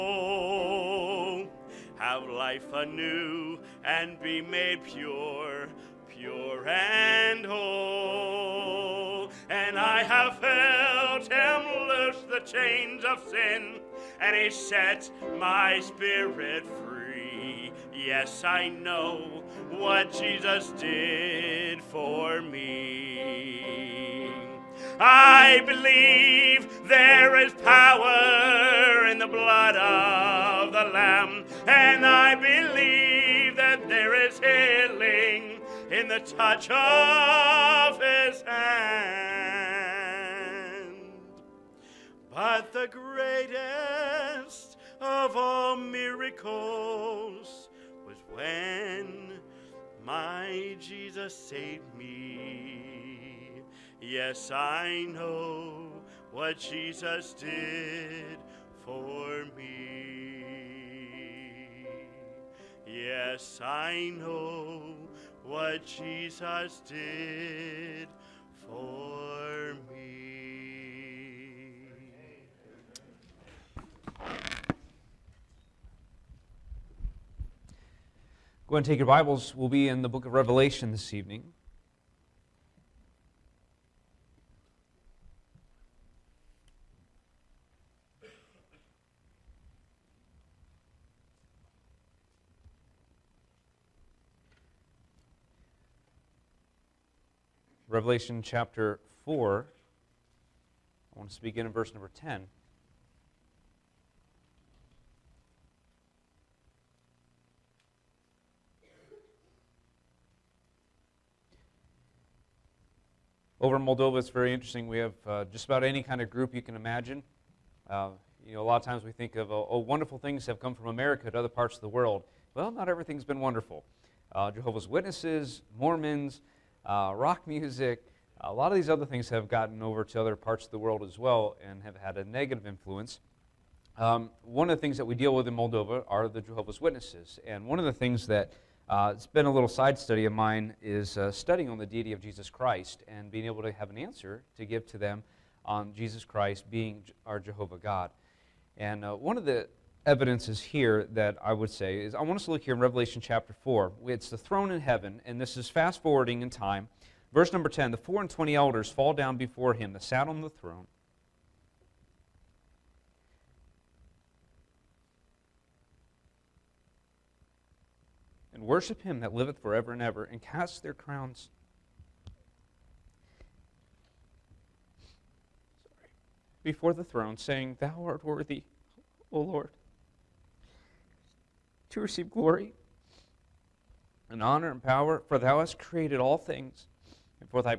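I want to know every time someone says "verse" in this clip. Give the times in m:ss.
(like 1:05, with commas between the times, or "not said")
1:41, 2:37.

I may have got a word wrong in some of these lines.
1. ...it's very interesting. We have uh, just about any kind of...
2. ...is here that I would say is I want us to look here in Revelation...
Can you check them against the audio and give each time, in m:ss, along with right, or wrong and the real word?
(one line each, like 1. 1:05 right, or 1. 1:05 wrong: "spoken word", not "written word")
1. 1:54 right
2. 2:30 right.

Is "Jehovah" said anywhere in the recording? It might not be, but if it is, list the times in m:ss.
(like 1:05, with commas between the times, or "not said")
2:04, 2:16, 2:27.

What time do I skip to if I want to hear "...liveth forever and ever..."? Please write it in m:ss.
2:49.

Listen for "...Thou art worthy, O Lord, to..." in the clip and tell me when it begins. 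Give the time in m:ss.
2:57.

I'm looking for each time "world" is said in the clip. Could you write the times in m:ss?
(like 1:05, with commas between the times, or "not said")
2:01, 2:10.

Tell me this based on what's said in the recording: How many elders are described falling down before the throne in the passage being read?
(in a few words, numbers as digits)
24.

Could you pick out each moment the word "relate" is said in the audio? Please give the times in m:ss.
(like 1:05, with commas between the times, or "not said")
not said.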